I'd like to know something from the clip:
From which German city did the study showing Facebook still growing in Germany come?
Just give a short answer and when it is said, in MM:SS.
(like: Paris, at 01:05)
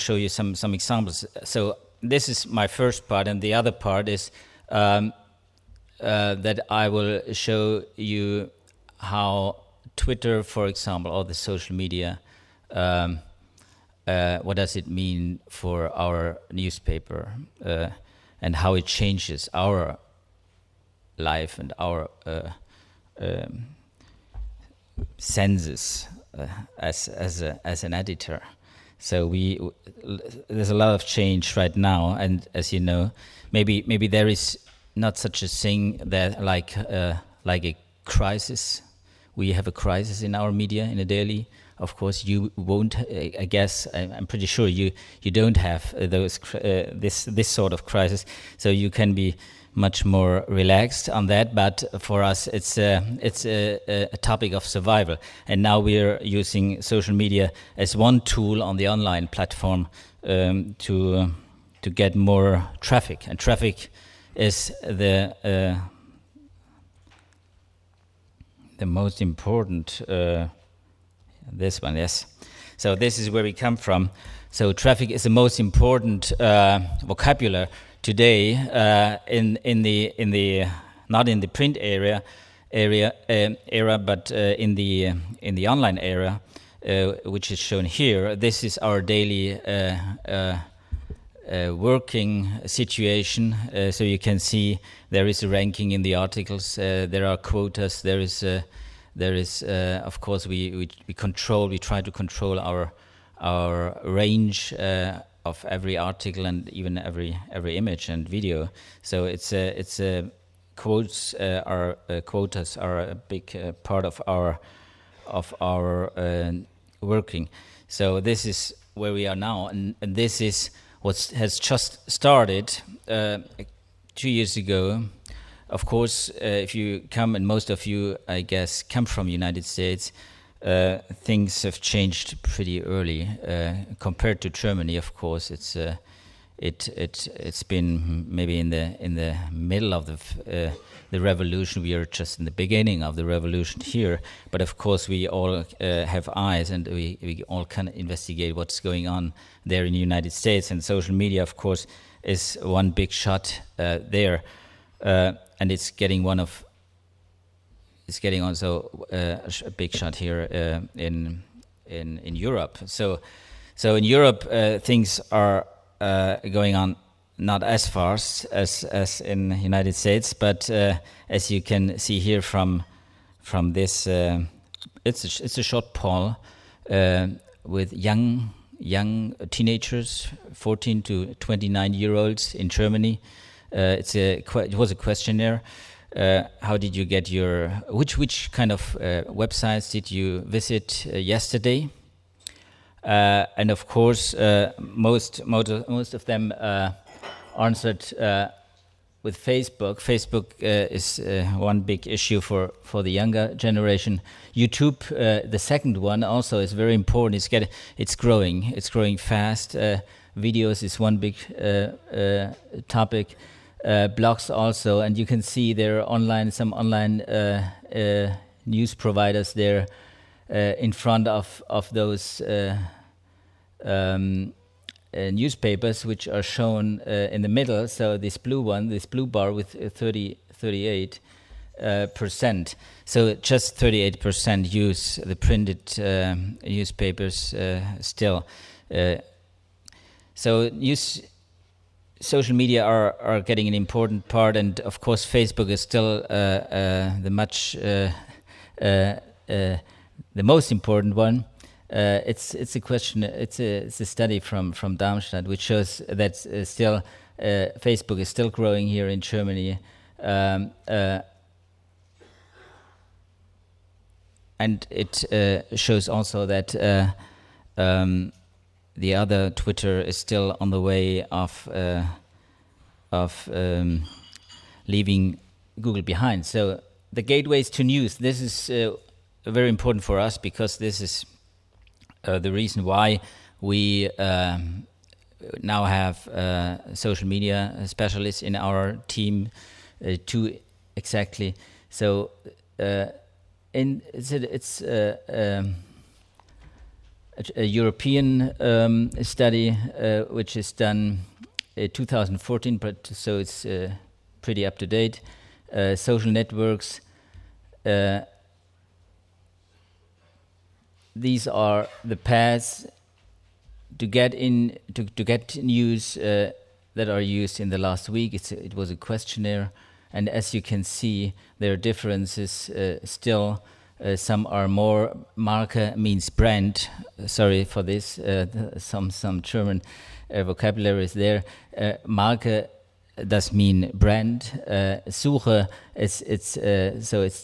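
Darmstadt, at 04:14.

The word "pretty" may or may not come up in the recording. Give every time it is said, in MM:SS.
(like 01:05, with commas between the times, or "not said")
00:44, 02:12, 05:04.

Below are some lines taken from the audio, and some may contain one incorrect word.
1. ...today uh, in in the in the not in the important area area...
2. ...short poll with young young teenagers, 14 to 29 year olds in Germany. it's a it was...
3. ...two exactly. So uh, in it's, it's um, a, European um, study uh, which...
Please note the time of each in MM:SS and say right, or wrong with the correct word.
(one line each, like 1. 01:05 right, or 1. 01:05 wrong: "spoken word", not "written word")
1. 01:18 wrong: "print", not "important"
2. 02:55 right
3. 04:50 right.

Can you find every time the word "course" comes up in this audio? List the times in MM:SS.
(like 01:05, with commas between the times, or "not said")
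00:41, 01:40, 02:05, 02:15, 02:24, 02:31, 03:13, 04:05.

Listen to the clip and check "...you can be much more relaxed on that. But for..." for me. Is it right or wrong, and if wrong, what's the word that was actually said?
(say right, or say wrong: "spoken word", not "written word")
right.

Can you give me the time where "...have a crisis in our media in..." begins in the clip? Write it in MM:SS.
00:39.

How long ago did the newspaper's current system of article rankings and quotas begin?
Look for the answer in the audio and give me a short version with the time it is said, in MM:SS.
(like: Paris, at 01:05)
Two years ago, at 02:04.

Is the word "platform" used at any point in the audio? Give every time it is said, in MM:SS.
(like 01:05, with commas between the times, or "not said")
00:59.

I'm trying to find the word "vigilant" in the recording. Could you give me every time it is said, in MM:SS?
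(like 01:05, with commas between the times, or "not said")
not said.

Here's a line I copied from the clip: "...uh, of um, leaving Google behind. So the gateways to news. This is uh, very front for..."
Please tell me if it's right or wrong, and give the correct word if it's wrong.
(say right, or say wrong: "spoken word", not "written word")
wrong: "important", not "front".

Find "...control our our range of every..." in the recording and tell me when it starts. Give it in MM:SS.
01:42.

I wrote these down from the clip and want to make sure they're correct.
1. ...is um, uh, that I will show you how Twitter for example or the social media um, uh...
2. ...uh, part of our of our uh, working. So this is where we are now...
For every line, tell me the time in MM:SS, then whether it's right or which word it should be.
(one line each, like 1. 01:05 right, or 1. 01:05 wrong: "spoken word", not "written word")
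1. 00:04 right
2. 01:53 right.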